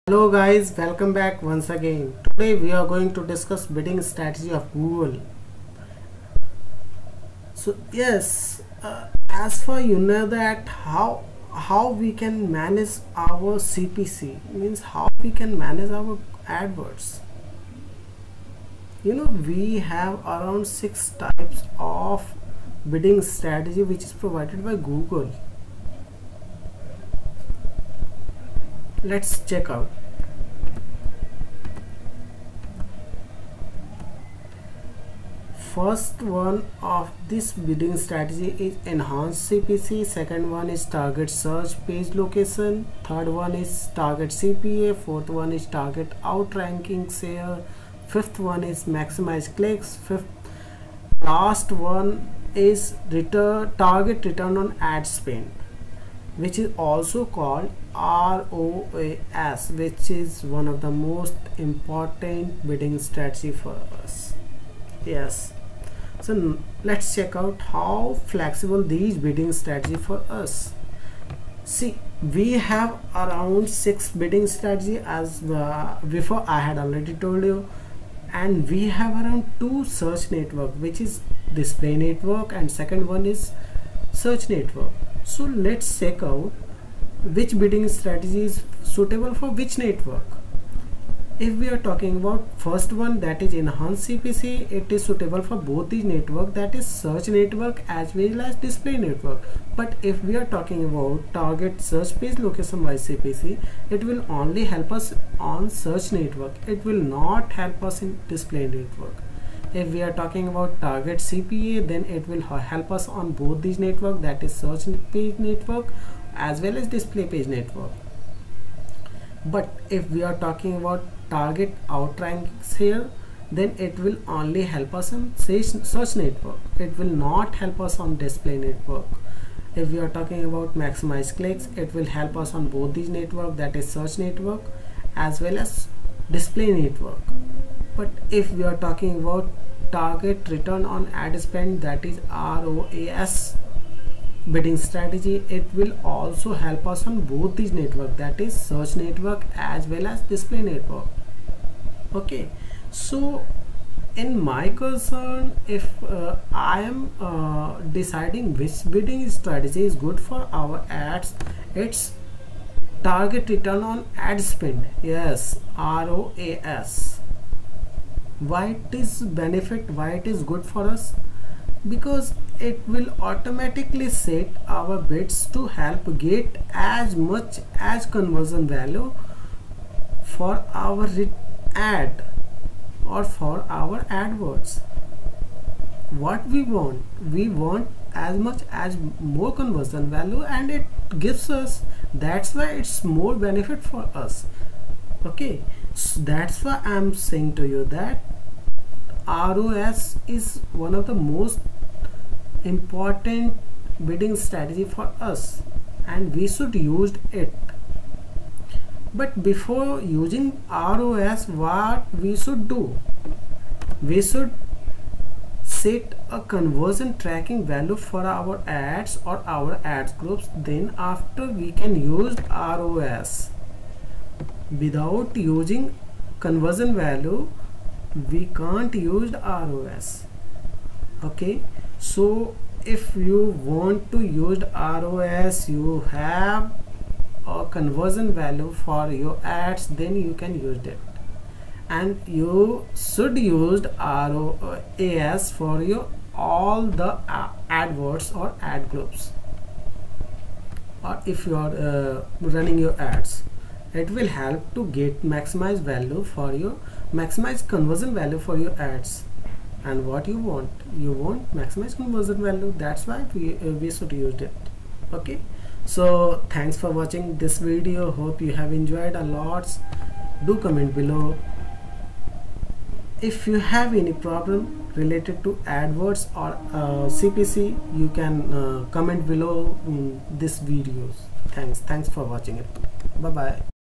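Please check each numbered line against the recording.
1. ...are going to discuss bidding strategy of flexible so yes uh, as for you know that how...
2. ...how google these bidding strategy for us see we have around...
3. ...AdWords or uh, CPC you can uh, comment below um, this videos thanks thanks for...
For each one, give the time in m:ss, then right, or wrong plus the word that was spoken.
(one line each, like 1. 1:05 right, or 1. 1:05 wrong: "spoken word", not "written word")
1. 0:02 wrong: "google", not "flexible"
2. 1:07 wrong: "flexible", not "google"
3. 4:35 right.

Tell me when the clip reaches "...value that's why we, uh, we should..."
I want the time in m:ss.
4:22.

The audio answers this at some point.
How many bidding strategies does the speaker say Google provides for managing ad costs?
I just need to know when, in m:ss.
0:20.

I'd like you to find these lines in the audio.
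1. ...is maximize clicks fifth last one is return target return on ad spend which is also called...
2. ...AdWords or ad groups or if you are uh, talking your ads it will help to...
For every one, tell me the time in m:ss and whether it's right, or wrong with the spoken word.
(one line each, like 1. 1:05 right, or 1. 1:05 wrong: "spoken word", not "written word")
1. 0:48 right
2. 4:07 wrong: "running", not "talking".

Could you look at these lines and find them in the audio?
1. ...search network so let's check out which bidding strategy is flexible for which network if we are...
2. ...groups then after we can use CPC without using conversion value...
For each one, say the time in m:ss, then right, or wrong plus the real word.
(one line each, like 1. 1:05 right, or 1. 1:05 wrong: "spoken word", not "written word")
1. 1:24 wrong: "suitable", not "flexible"
2. 3:40 wrong: "ROAS", not "CPC".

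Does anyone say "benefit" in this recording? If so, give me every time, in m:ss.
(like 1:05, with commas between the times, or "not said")
2:49, 3:13.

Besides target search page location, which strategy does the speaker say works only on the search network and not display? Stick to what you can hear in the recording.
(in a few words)
target outrank share.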